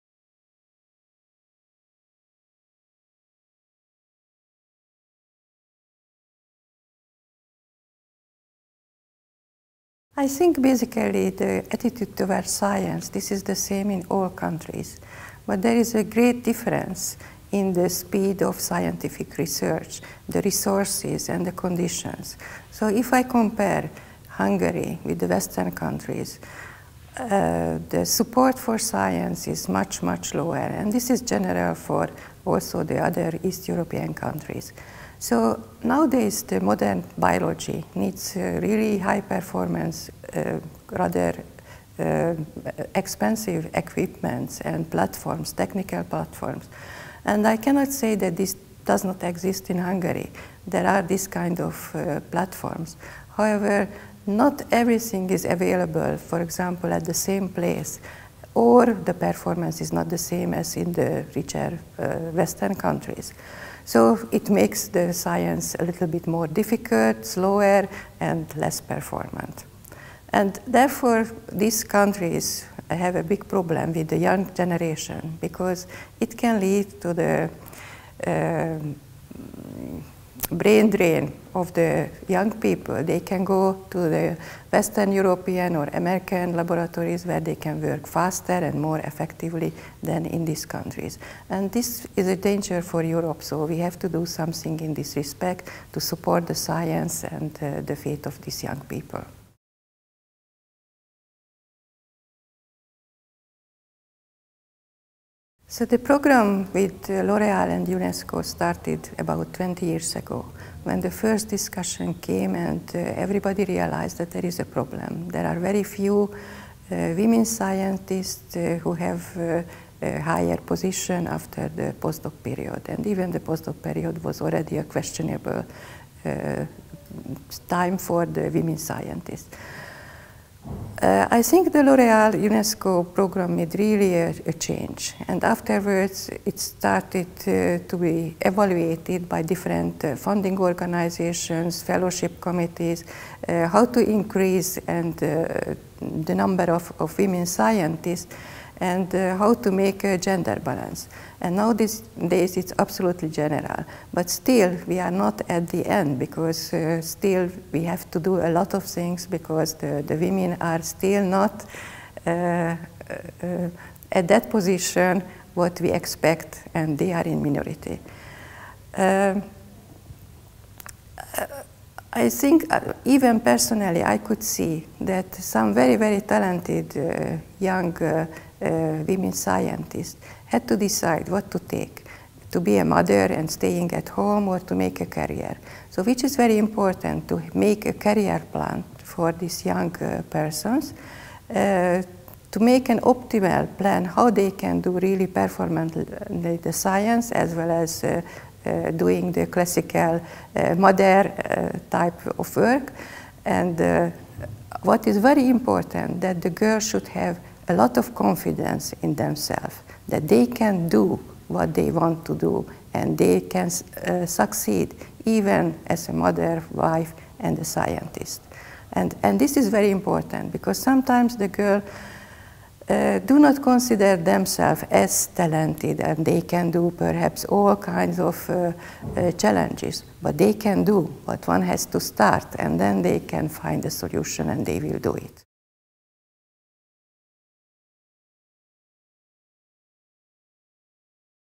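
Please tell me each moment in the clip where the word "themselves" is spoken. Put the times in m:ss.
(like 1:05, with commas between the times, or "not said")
3:29, 3:44.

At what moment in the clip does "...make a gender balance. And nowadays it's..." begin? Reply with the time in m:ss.
2:29.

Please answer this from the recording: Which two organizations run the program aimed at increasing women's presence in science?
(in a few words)
L'Oreal and UNESCO.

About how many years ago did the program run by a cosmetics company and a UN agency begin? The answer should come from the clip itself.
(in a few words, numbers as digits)
20 years.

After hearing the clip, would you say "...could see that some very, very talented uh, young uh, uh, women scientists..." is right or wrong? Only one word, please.
right.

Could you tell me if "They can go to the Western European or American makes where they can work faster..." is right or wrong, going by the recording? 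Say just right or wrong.
wrong.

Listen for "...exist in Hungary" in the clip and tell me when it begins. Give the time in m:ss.
0:49.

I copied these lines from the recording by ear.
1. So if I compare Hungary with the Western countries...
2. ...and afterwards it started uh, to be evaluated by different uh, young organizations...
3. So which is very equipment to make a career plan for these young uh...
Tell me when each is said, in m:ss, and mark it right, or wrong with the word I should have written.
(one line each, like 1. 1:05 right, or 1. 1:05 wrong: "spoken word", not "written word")
1. 0:22 right
2. 2:15 wrong: "funding", not "young"
3. 3:05 wrong: "important", not "equipment".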